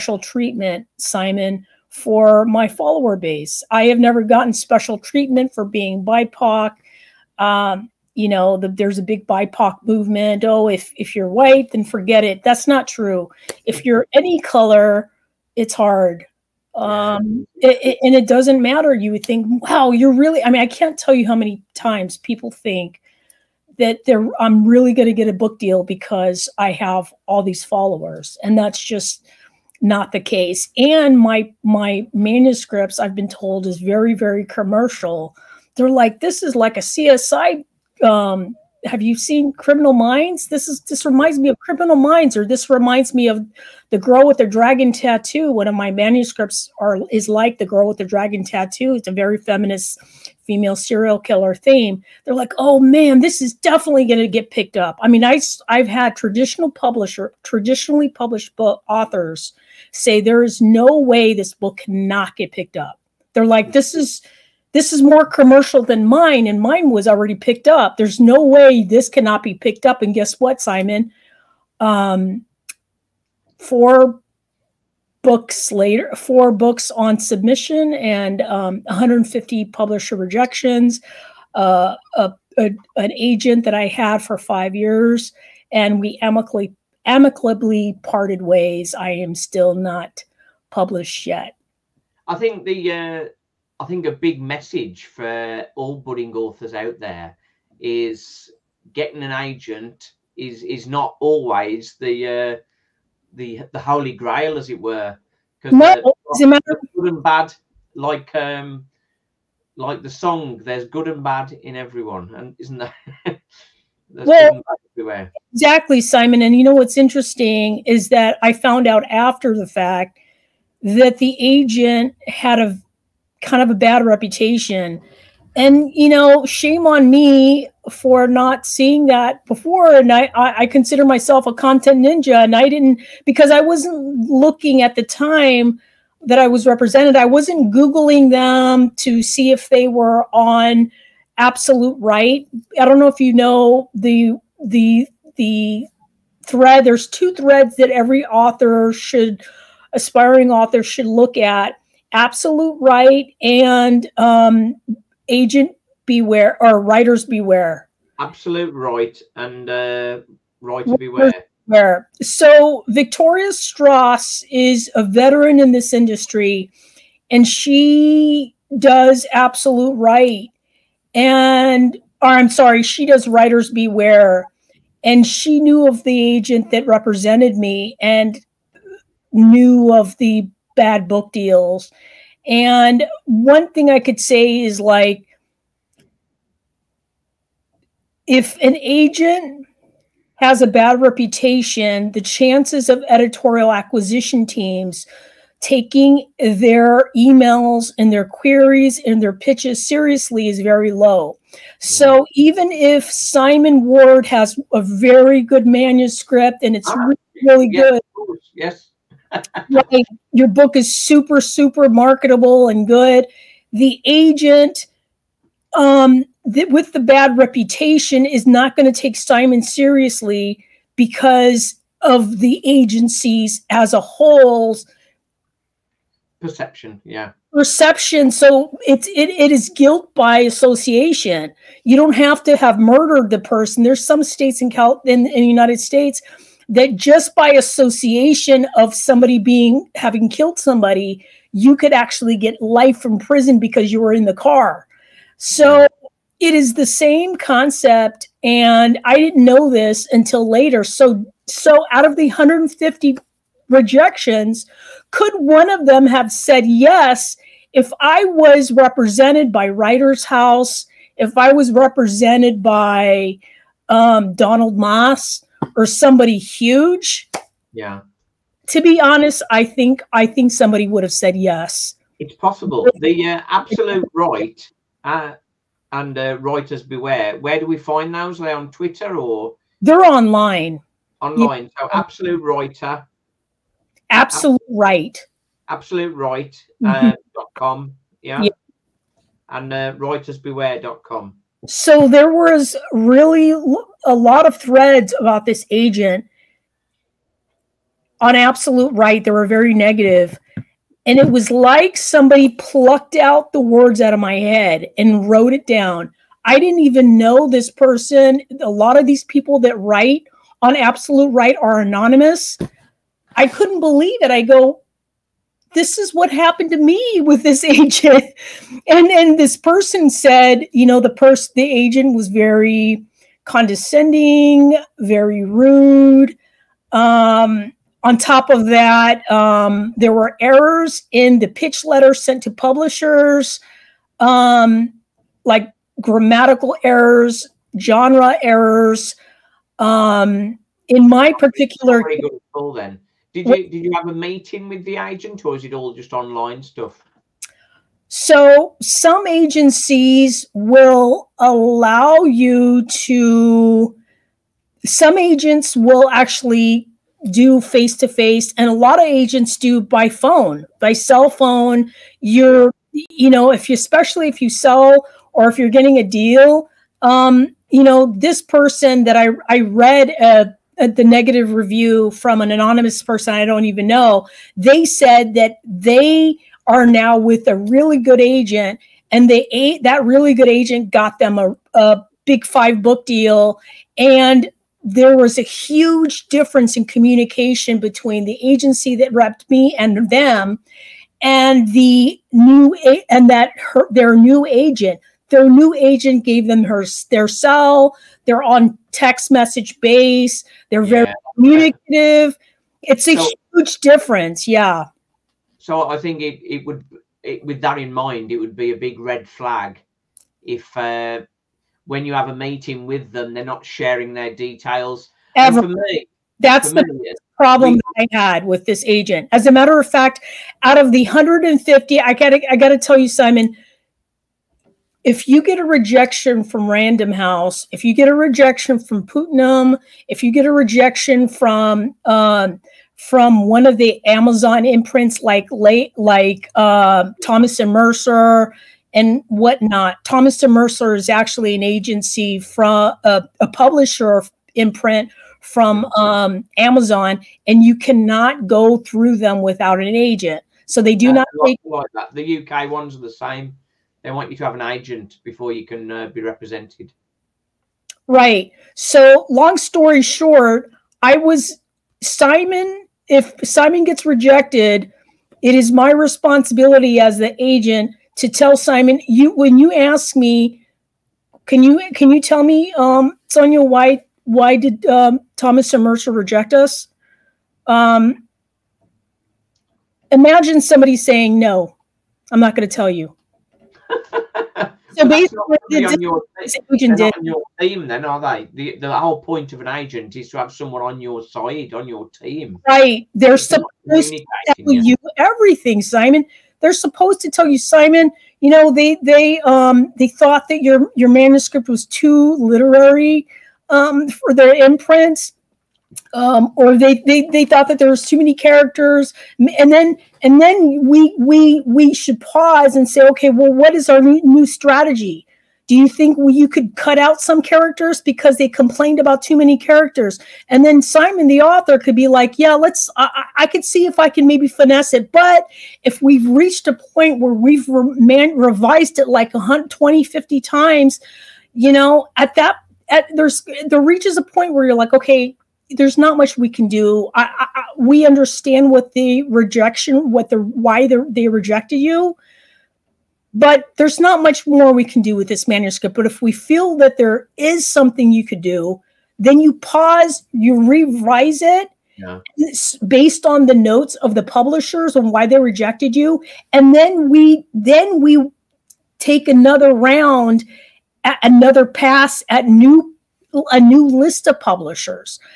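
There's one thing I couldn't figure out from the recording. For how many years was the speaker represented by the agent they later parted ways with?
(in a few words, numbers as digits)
5.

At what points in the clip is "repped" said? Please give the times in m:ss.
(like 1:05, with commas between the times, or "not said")
6:29.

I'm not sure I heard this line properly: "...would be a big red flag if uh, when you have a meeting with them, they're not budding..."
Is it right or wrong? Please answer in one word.
wrong.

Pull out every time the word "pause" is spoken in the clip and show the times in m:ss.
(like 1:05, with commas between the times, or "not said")
8:32, 9:09.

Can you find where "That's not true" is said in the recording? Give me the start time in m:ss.
0:12.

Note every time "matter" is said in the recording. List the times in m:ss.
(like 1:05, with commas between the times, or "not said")
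0:18, 6:59.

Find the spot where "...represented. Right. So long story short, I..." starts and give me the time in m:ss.
7:36.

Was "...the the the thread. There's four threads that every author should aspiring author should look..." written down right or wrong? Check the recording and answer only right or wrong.
wrong.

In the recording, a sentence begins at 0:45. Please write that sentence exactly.
One of my manuscripts are is like the girl with the dragon tattoo.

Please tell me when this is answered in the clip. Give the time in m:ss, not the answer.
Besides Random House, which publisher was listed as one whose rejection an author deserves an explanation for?
7:09.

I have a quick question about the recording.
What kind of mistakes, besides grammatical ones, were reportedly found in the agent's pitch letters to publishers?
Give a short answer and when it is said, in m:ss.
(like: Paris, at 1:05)
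Genre errors, at 5:37.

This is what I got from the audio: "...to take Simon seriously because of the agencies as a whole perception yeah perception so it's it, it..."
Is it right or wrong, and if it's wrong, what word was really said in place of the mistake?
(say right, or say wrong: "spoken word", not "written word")
right.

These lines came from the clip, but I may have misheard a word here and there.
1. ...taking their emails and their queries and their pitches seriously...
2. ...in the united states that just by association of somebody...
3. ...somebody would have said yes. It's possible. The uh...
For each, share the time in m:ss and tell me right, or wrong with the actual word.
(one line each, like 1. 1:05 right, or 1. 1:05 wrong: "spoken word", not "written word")
1. 3:15 right
2. 3:55 right
3. 4:30 right.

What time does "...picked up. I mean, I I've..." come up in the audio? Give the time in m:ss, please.
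0:54.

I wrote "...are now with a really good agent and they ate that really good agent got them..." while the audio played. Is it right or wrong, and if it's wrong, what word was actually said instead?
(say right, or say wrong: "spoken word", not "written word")
right.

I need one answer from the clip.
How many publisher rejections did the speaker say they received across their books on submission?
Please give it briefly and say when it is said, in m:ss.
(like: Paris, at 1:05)
150, at 1:18.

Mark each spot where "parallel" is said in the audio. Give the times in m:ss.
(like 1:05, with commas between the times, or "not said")
not said.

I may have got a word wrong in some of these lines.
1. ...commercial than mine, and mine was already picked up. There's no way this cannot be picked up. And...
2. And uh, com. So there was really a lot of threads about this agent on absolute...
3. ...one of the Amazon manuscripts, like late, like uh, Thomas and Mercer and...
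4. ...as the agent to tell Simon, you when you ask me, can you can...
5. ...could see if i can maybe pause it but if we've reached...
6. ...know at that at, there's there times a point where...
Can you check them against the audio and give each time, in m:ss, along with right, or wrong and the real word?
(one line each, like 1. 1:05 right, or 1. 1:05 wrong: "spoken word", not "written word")
1. 1:05 right
2. 4:49 right
3. 7:13 wrong: "imprints", not "manuscripts"
4. 7:46 right
5. 8:43 wrong: "finesse", not "pause"
6. 8:51 wrong: "reaches", not "times".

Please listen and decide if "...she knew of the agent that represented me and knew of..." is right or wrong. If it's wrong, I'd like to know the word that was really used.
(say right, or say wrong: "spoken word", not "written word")
right.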